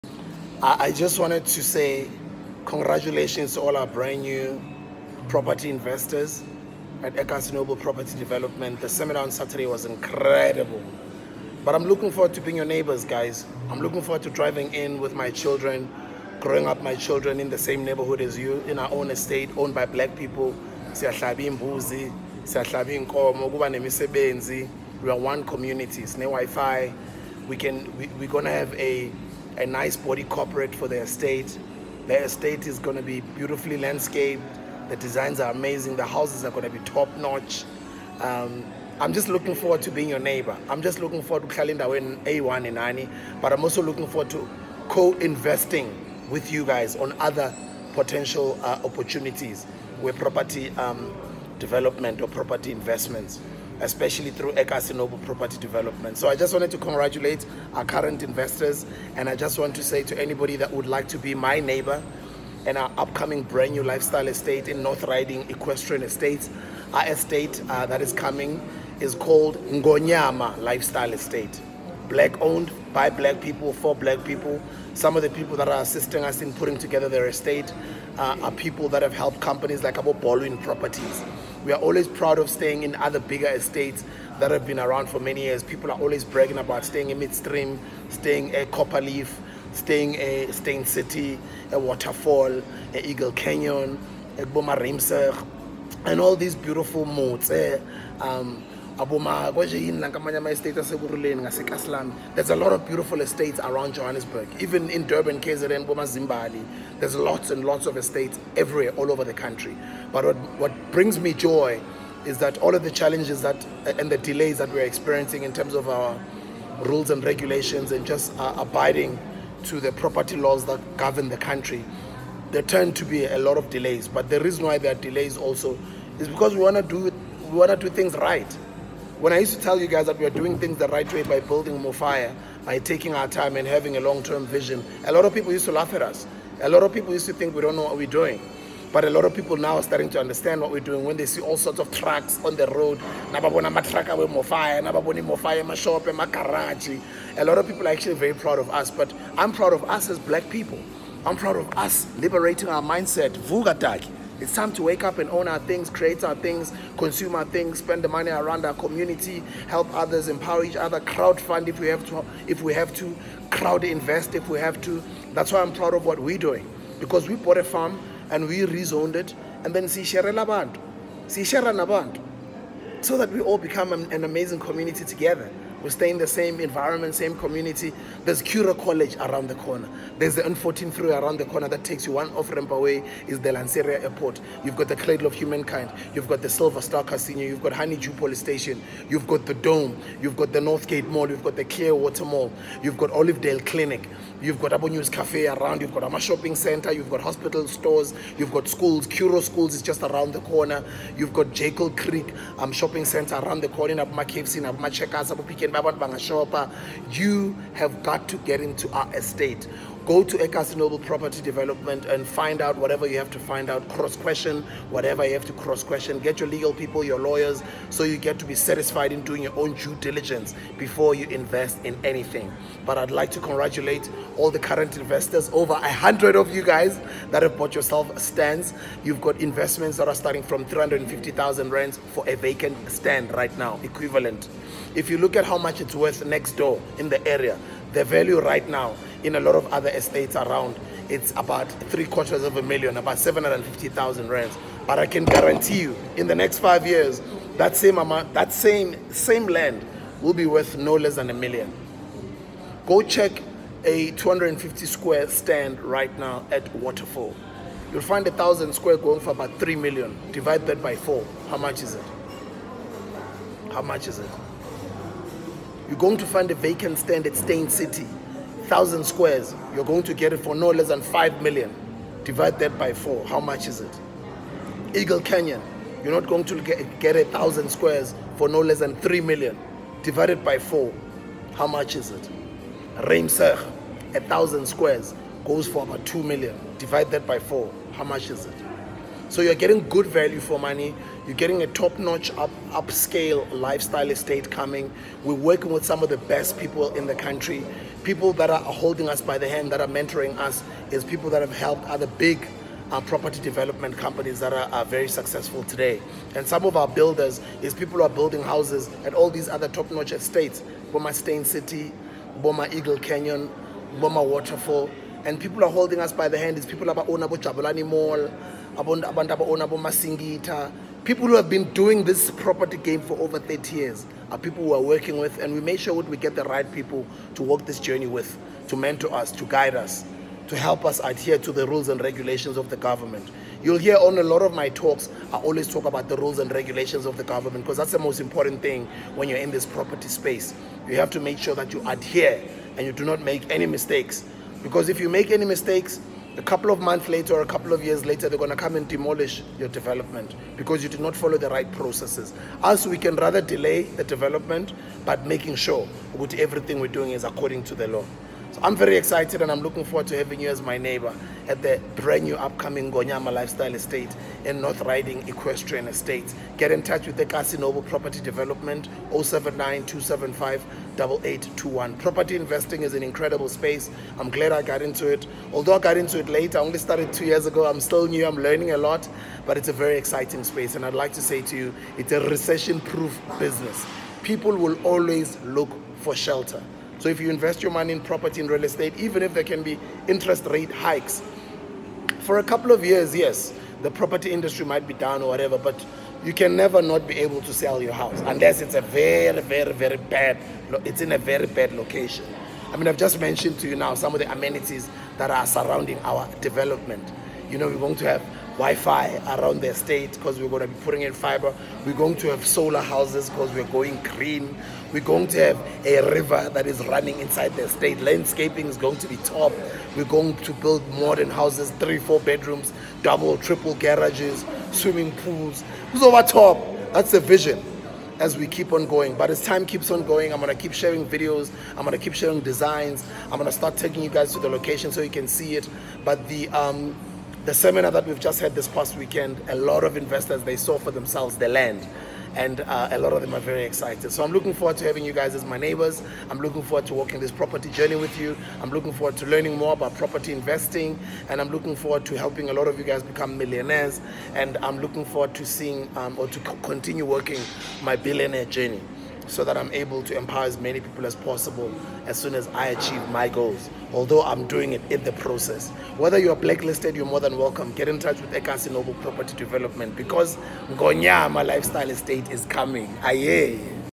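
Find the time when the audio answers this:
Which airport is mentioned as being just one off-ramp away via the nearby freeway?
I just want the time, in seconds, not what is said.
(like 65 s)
183 s.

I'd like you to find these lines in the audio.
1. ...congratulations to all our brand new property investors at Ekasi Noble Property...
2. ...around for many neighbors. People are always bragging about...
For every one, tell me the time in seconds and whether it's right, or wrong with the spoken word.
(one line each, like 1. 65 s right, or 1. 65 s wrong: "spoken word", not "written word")
1. 2 s right
2. 84 s wrong: "years", not "neighbors".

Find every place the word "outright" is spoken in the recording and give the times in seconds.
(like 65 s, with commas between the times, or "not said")
not said.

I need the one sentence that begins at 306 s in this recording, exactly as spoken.
And some of our builders is people who are building houses at all these other top-notch estates.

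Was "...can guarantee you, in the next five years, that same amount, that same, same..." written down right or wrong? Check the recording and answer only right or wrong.
right.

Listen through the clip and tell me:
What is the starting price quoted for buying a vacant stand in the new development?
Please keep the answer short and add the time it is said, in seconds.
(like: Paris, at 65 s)
350,000 rands, at 230 s.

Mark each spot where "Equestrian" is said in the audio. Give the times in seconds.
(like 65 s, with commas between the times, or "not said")
65 s, 365 s.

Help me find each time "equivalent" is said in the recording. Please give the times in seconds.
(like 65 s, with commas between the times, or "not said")
233 s.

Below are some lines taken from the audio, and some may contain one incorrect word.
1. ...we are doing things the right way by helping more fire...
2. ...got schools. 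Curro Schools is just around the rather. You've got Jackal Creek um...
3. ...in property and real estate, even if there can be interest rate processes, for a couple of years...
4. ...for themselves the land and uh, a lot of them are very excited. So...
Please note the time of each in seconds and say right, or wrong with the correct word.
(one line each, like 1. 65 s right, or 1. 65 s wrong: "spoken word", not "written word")
1. 130 s wrong: "building", not "helping"
2. 198 s wrong: "corner", not "rather"
3. 387 s wrong: "hikes", not "processes"
4. 440 s right.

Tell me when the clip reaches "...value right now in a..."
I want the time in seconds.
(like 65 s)
238 s.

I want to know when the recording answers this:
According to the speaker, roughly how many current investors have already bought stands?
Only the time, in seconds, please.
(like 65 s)
225 s.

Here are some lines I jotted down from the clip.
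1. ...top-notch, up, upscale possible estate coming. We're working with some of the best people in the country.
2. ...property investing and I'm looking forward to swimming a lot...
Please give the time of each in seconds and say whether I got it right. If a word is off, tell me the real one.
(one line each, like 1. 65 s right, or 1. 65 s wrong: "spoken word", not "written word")
1. 291 s wrong: "lifestyle", not "possible"
2. 449 s wrong: "helping", not "swimming".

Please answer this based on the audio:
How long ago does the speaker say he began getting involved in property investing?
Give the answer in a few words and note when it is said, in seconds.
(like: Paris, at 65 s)
2 years ago, at 377 s.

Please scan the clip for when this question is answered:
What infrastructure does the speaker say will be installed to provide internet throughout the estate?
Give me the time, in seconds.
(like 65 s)
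411 s.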